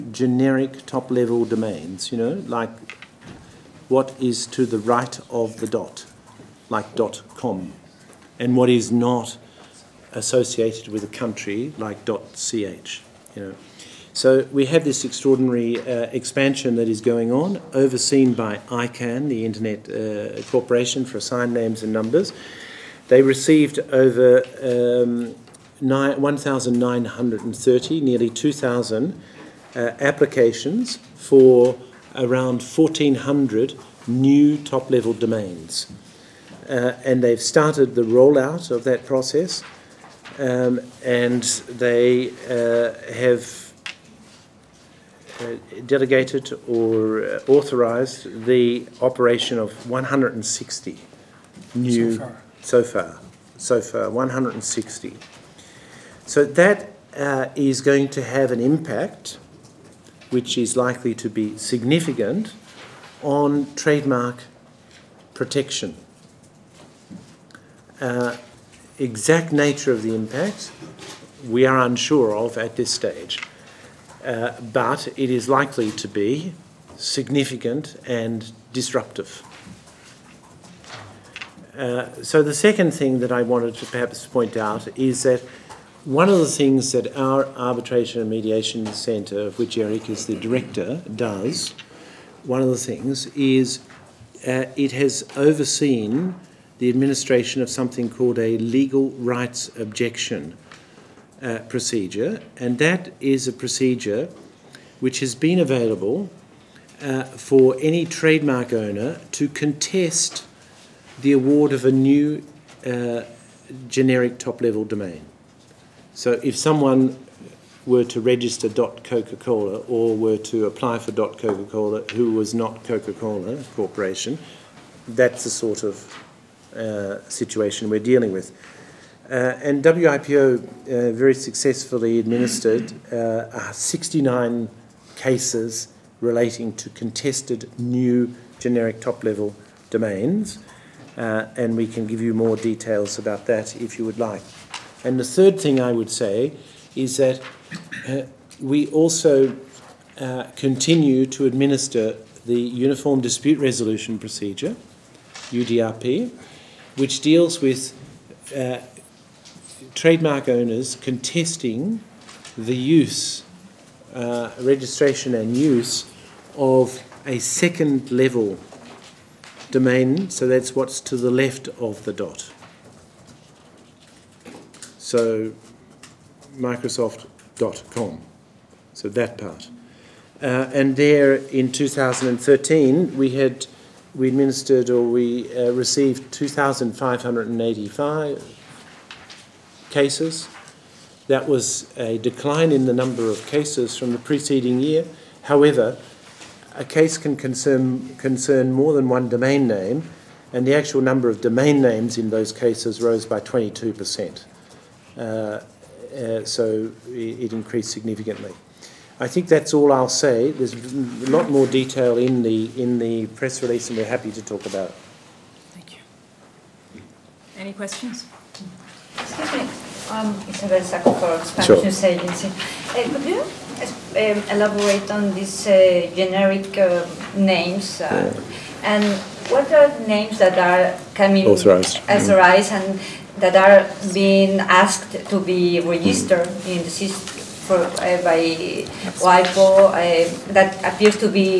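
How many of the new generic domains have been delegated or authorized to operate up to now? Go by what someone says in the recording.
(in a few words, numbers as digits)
160.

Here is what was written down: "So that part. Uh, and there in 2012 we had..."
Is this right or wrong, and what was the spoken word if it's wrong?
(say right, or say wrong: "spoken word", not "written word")
wrong: "2013", not "2012".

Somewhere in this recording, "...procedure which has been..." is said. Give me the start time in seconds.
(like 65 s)
103 s.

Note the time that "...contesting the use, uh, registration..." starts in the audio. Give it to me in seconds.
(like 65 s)
160 s.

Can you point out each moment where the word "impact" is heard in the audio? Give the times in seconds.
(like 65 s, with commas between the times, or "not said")
58 s, 70 s.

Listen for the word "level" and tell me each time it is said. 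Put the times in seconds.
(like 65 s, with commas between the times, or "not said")
1 s, 34 s, 114 s, 138 s, 168 s.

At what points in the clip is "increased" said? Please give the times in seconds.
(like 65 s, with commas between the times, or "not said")
207 s.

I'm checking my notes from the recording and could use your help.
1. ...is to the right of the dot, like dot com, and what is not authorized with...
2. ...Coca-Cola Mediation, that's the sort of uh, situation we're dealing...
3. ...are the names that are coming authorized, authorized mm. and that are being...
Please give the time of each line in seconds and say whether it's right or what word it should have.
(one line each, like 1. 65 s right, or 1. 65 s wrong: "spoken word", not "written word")
1. 4 s wrong: "associated", not "authorized"
2. 122 s wrong: "Corporation", not "Mediation"
3. 229 s right.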